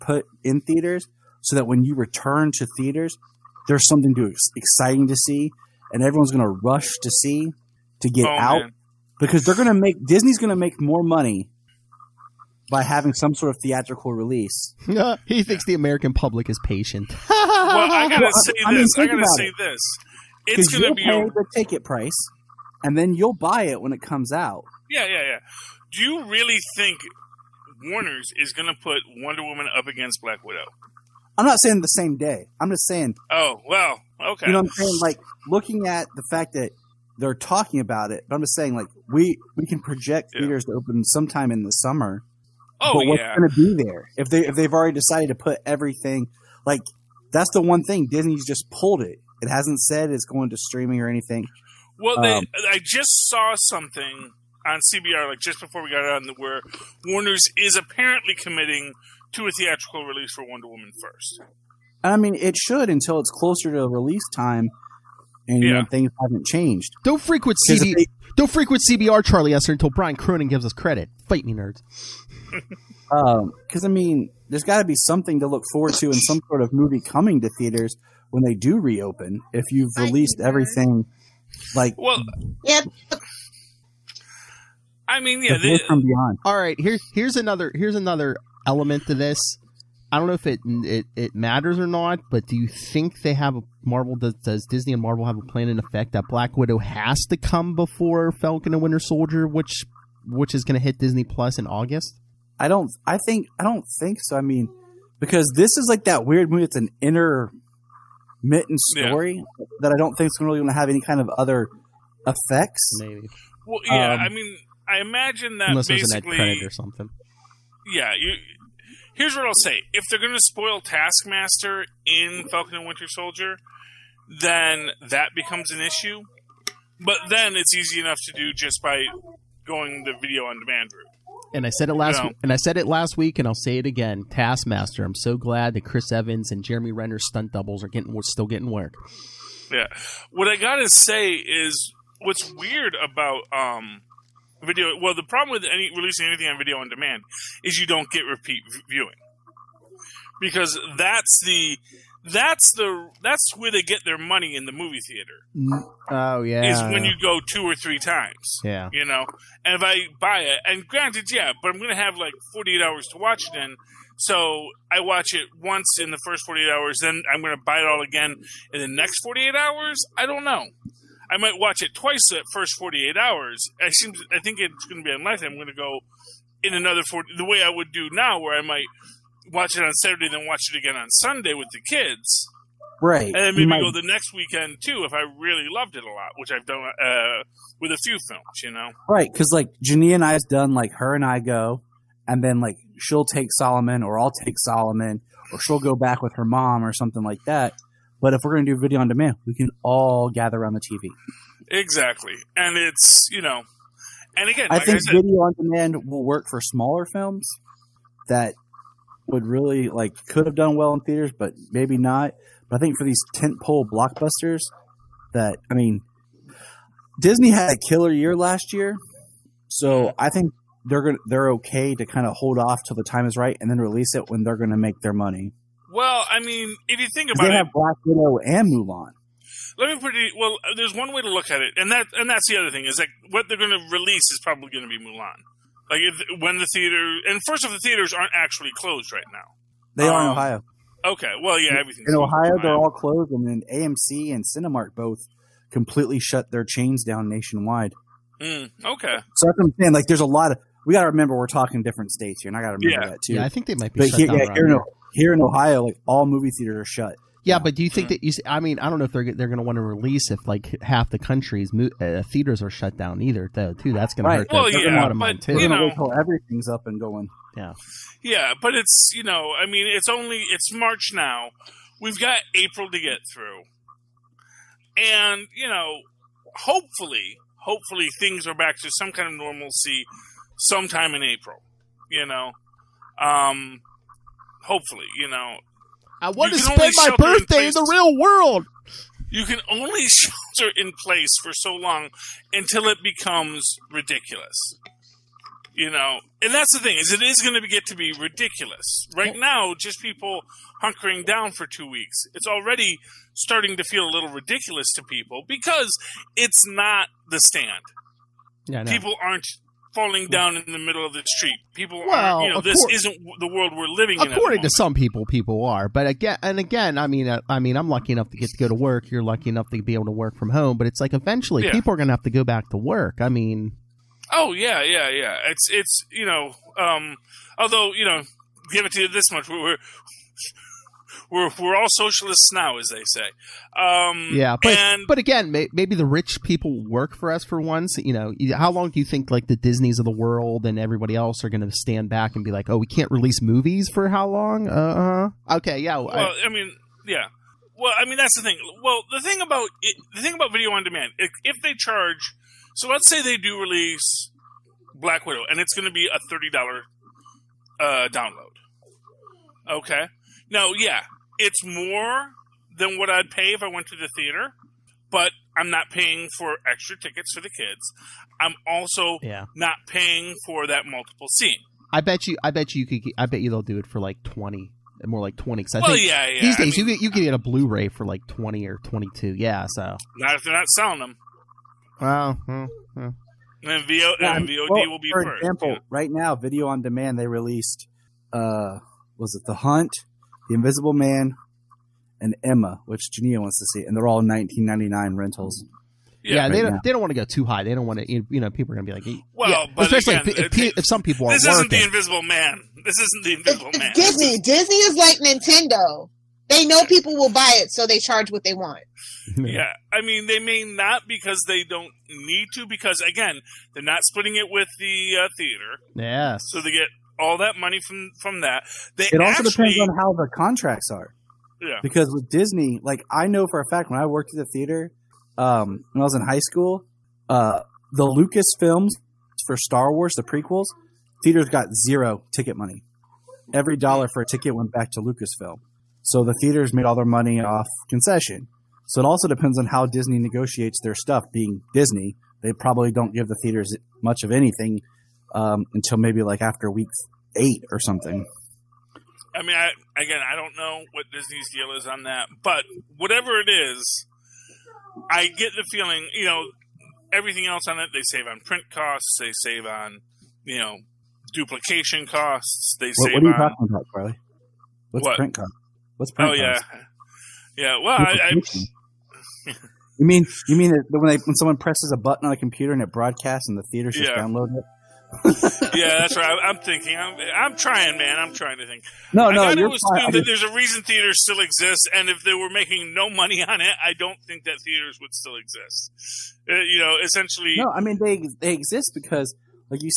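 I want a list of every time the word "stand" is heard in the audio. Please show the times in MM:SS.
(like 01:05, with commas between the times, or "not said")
05:07, 05:41.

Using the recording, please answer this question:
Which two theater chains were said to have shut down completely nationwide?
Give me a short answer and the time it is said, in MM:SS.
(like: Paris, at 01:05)
AMC and Cinemark, at 04:03.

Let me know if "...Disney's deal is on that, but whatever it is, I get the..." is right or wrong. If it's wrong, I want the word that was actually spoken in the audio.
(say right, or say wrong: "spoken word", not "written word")
right.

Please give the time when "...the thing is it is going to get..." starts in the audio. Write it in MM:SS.
04:56.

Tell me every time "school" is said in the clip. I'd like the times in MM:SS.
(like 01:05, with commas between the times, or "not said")
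07:06.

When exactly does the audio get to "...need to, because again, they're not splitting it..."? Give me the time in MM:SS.
06:52.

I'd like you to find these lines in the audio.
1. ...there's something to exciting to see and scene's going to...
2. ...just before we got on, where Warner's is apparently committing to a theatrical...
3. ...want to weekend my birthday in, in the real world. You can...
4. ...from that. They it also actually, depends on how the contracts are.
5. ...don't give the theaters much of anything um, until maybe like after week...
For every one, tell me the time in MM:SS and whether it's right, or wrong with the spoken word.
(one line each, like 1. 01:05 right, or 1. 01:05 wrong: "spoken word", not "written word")
1. 00:03 wrong: "everyone", not "scene"
2. 00:55 right
3. 04:46 wrong: "spend", not "weekend"
4. 06:58 right
5. 07:22 right.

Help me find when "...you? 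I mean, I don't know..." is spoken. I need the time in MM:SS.
04:18.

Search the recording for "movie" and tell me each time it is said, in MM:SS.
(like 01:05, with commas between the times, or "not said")
01:16, 01:46, 02:34, 04:16, 05:43.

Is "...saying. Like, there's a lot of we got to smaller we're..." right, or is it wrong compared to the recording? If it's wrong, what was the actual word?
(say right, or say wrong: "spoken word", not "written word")
wrong: "remember", not "smaller".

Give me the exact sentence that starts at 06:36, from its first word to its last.
Yeah, yeah right they don't, they don't want to go too high.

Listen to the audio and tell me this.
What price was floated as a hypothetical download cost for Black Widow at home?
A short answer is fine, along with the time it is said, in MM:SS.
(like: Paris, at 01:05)
$30, at 05:56.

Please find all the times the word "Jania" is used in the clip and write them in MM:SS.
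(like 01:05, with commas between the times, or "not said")
03:09, 06:33.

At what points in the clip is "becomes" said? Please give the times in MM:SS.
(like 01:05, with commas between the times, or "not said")
02:05, 04:53.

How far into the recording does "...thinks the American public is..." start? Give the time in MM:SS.
00:15.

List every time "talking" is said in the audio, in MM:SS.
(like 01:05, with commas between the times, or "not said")
00:37, 04:11, 07:43.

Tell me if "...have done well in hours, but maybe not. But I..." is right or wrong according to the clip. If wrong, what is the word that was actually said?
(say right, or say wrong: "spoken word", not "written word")
wrong: "theaters", not "hours".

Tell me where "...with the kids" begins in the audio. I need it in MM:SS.
03:01.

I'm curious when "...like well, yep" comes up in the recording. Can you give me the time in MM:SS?
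01:21.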